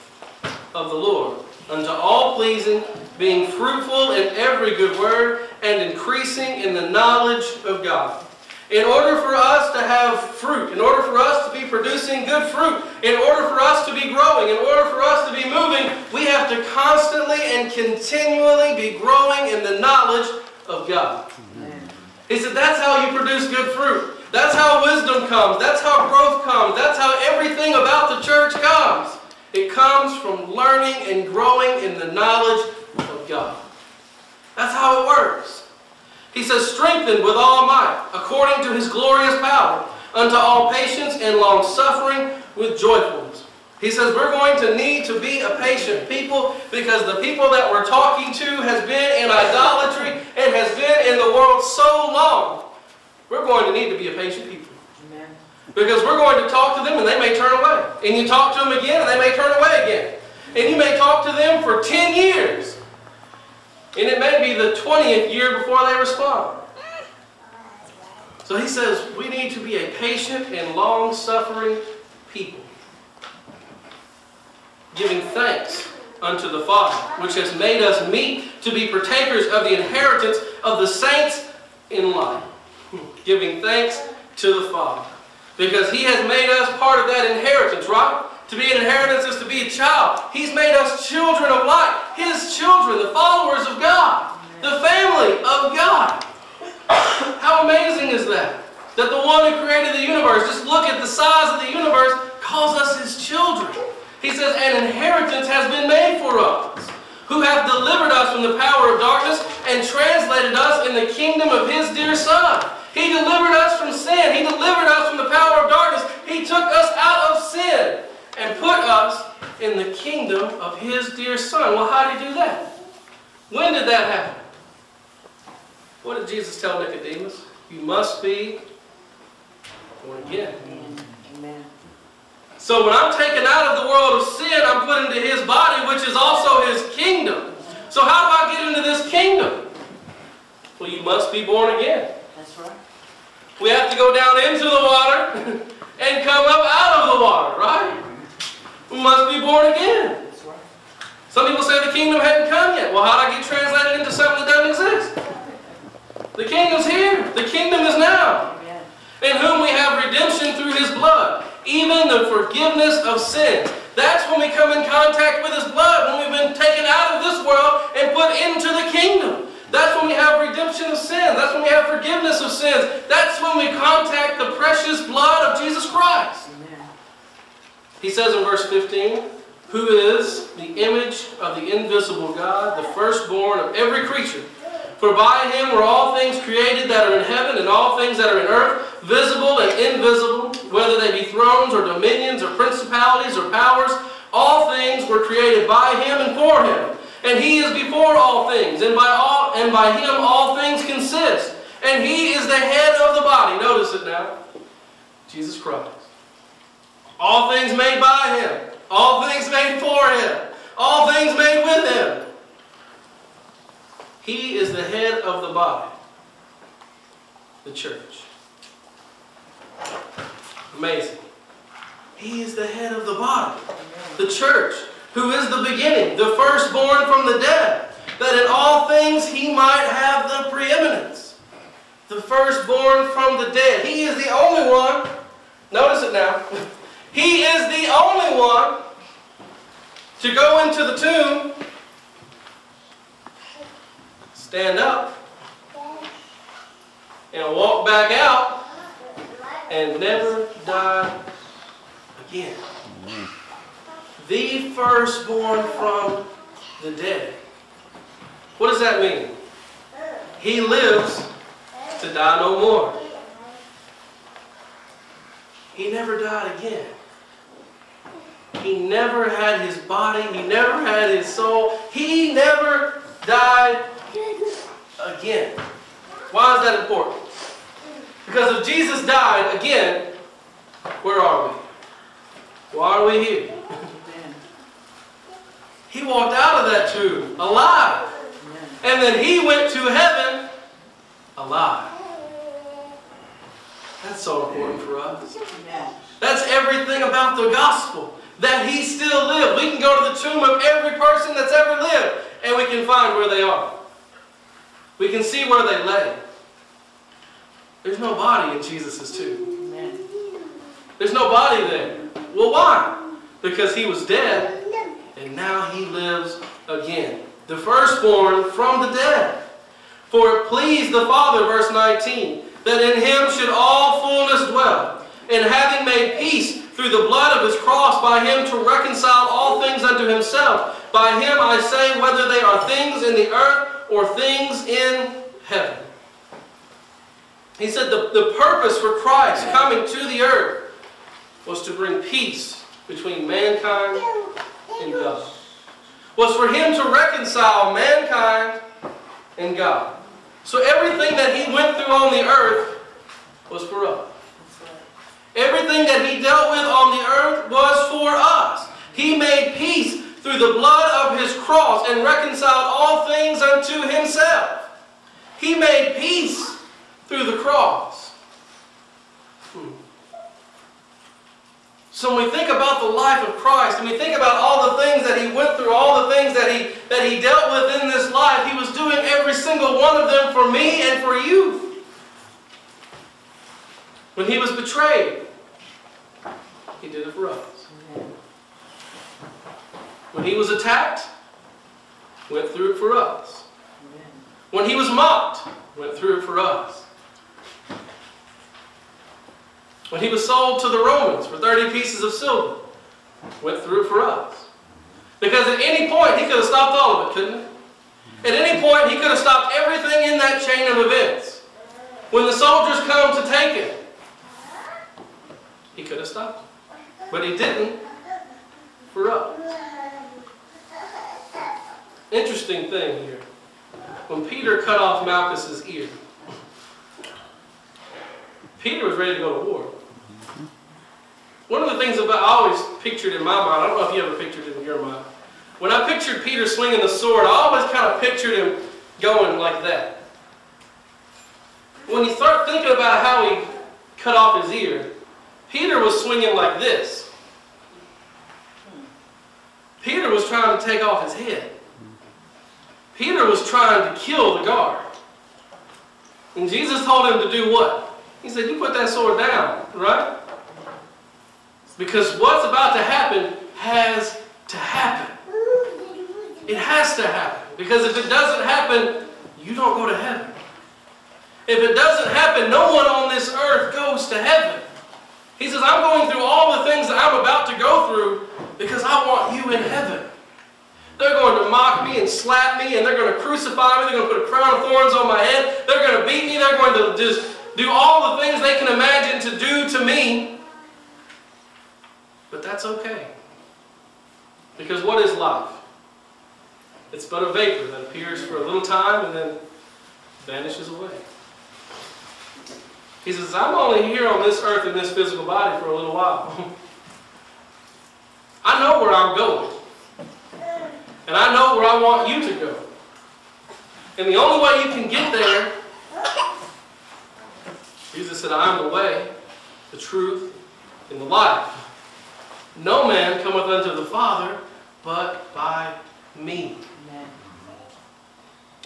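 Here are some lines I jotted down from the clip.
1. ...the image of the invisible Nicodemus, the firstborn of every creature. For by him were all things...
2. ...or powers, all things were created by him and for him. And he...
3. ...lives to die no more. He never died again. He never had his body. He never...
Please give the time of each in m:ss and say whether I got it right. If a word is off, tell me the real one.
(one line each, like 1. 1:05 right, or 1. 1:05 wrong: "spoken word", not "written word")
1. 3:00 wrong: "God", not "Nicodemus"
2. 3:13 right
3. 4:20 right.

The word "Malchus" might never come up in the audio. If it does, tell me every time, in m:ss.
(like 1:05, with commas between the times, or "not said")
7:05.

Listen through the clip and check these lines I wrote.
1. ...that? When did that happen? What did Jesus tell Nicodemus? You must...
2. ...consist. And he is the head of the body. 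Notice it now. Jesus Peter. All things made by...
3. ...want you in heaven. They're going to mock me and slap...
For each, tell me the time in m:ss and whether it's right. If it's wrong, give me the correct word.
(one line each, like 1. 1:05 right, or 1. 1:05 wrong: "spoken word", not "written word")
1. 2:02 right
2. 3:20 wrong: "Christ", not "Peter"
3. 7:59 right.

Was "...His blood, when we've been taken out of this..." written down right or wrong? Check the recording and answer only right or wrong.
right.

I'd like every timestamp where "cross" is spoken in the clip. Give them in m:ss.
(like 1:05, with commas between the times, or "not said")
5:27, 6:01, 6:07.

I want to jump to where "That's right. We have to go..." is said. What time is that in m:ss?
2:22.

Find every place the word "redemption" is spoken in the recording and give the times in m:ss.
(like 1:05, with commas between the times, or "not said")
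2:40, 2:50.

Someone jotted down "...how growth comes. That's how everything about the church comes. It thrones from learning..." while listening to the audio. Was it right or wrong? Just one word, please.
wrong.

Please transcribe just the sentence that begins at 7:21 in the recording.
When you start thinking about how he cut off his ear, Peter was swinging like this.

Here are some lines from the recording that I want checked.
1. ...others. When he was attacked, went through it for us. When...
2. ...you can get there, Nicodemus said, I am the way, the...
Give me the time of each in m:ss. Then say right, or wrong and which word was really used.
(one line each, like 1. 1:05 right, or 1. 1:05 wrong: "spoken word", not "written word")
1. 6:27 right
2. 8:34 wrong: "Jesus", not "Nicodemus".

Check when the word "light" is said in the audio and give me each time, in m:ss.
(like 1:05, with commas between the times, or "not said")
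1:22, 1:31.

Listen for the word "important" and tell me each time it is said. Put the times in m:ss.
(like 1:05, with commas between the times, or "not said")
4:36, 4:54.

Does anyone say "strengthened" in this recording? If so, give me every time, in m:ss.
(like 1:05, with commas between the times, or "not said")
0:36.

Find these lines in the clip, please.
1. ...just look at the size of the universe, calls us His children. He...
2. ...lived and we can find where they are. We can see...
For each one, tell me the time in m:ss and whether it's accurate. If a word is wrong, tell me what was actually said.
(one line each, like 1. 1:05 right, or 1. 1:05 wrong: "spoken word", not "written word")
1. 1:40 right
2. 5:01 right.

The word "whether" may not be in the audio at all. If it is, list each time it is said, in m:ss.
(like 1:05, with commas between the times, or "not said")
3:10, 5:32.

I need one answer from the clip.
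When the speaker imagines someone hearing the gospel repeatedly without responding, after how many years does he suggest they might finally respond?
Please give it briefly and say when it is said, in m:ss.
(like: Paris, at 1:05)
20th year, at 1:04.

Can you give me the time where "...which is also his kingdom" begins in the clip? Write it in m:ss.
2:15.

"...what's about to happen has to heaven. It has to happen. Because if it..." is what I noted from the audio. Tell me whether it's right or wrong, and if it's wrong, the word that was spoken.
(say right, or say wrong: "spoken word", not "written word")
wrong: "happen", not "heaven".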